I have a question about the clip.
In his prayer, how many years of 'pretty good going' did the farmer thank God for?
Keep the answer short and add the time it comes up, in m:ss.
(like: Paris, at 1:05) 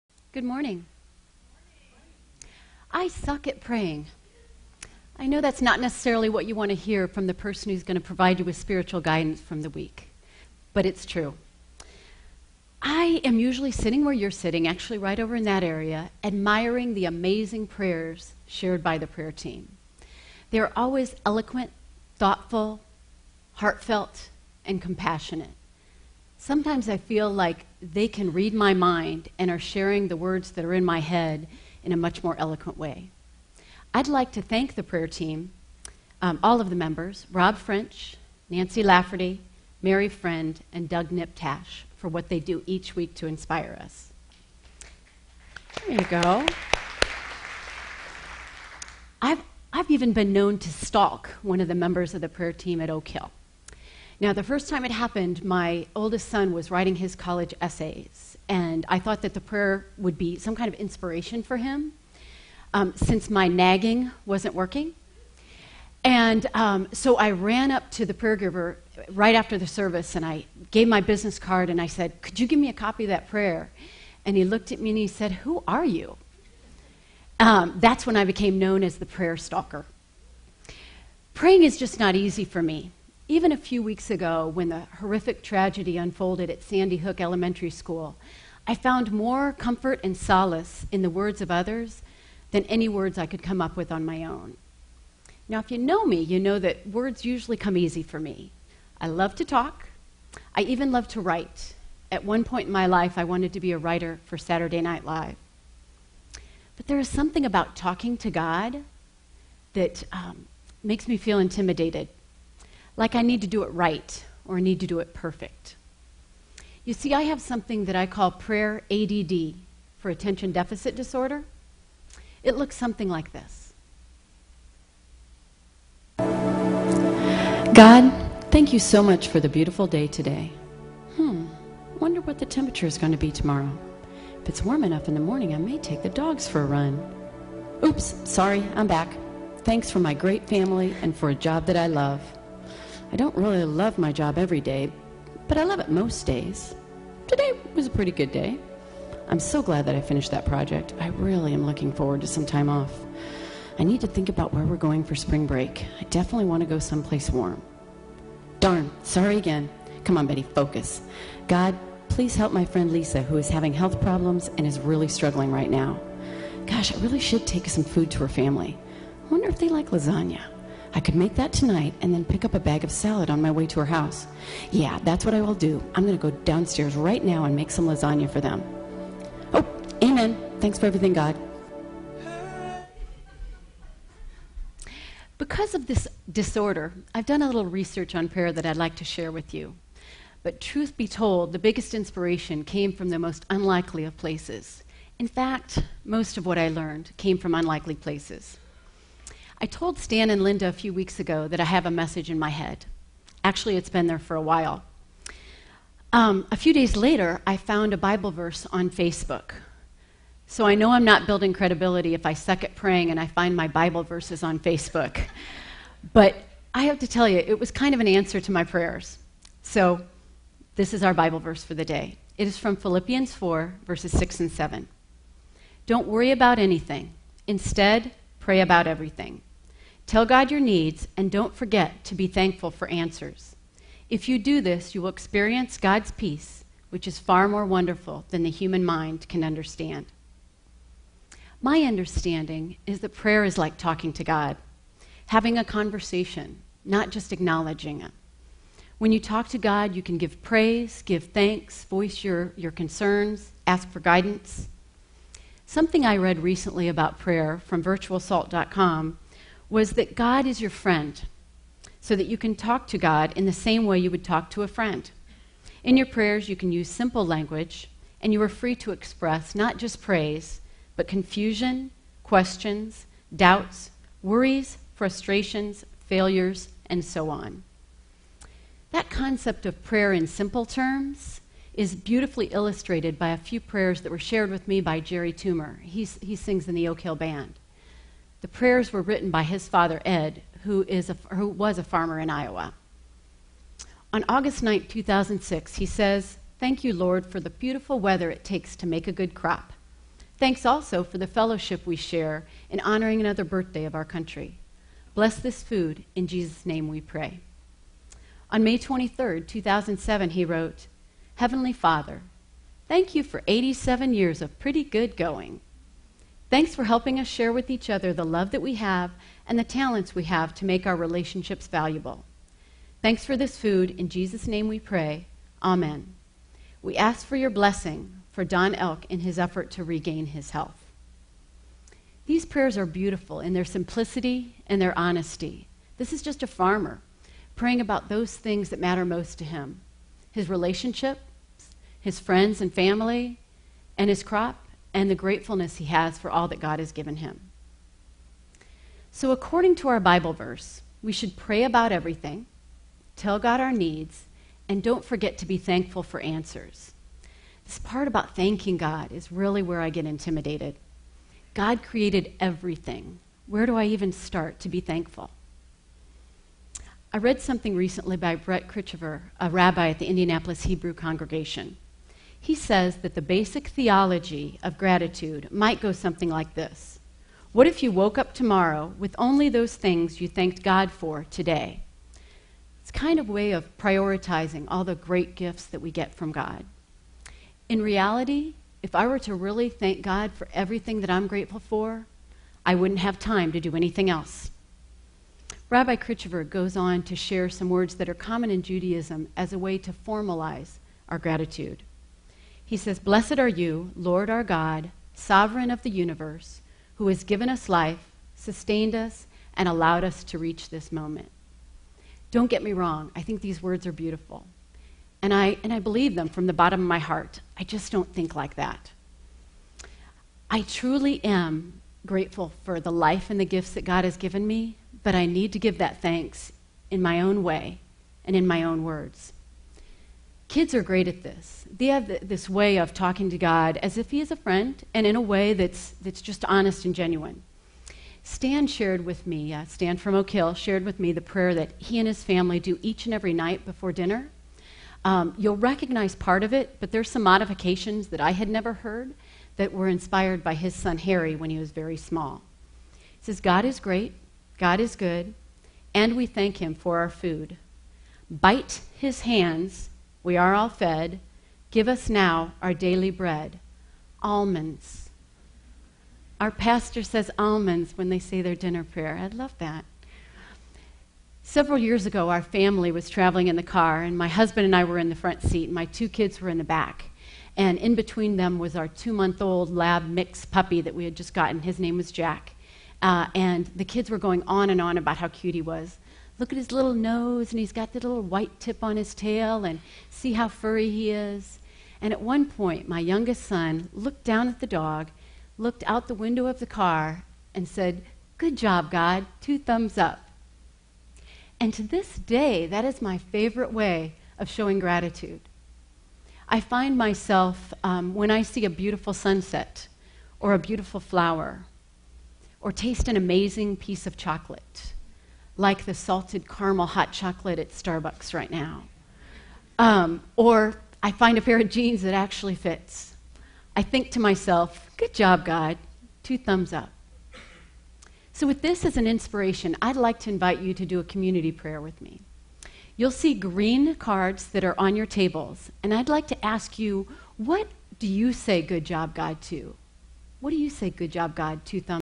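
87, at 5:13.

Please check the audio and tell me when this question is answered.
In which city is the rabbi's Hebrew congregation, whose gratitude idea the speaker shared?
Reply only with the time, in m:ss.
6:10.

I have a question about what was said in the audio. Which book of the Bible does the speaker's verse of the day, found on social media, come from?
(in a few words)
Philippians.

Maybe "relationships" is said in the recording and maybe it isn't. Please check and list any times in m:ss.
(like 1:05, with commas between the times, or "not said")
5:20, 5:40.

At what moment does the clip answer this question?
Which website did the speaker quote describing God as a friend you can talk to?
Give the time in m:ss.
4:17.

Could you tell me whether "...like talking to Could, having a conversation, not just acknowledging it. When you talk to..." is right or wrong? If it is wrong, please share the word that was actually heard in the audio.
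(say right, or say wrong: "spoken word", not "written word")
wrong: "God", not "Could".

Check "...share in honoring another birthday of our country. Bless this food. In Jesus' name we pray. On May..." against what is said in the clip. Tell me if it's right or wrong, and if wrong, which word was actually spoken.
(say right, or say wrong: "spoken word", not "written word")
right.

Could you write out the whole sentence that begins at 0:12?
I am usually sitting where you're sitting, actually right over in that area, admiring the amazing prayers shared by the prayer team.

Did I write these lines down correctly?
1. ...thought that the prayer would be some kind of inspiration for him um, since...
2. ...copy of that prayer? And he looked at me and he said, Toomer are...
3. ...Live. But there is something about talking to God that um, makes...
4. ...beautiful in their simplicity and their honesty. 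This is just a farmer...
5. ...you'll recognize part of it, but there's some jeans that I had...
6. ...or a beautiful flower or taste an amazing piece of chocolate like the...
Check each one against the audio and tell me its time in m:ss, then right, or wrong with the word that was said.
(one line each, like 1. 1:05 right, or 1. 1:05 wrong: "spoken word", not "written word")
1. 0:58 right
2. 1:12 wrong: "Who", not "Toomer"
3. 1:45 right
4. 5:32 right
5. 7:25 wrong: "modifications", not "jeans"
6. 8:30 right.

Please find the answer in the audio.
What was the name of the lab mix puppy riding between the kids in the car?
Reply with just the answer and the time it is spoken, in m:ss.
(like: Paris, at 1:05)
Jack, at 8:02.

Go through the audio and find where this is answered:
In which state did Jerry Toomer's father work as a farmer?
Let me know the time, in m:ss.
4:52.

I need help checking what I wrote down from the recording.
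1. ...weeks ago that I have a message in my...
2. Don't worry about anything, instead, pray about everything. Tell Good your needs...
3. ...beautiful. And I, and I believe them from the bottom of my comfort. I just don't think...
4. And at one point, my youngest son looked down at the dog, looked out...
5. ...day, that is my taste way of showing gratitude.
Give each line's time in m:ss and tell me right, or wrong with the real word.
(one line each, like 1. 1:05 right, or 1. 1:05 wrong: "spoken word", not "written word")
1. 3:20 right
2. 3:45 wrong: "God", not "Good"
3. 6:53 wrong: "heart", not "comfort"
4. 8:12 right
5. 8:22 wrong: "favorite", not "taste".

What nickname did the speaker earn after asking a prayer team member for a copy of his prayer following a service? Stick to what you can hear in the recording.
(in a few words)
the prayer stalker.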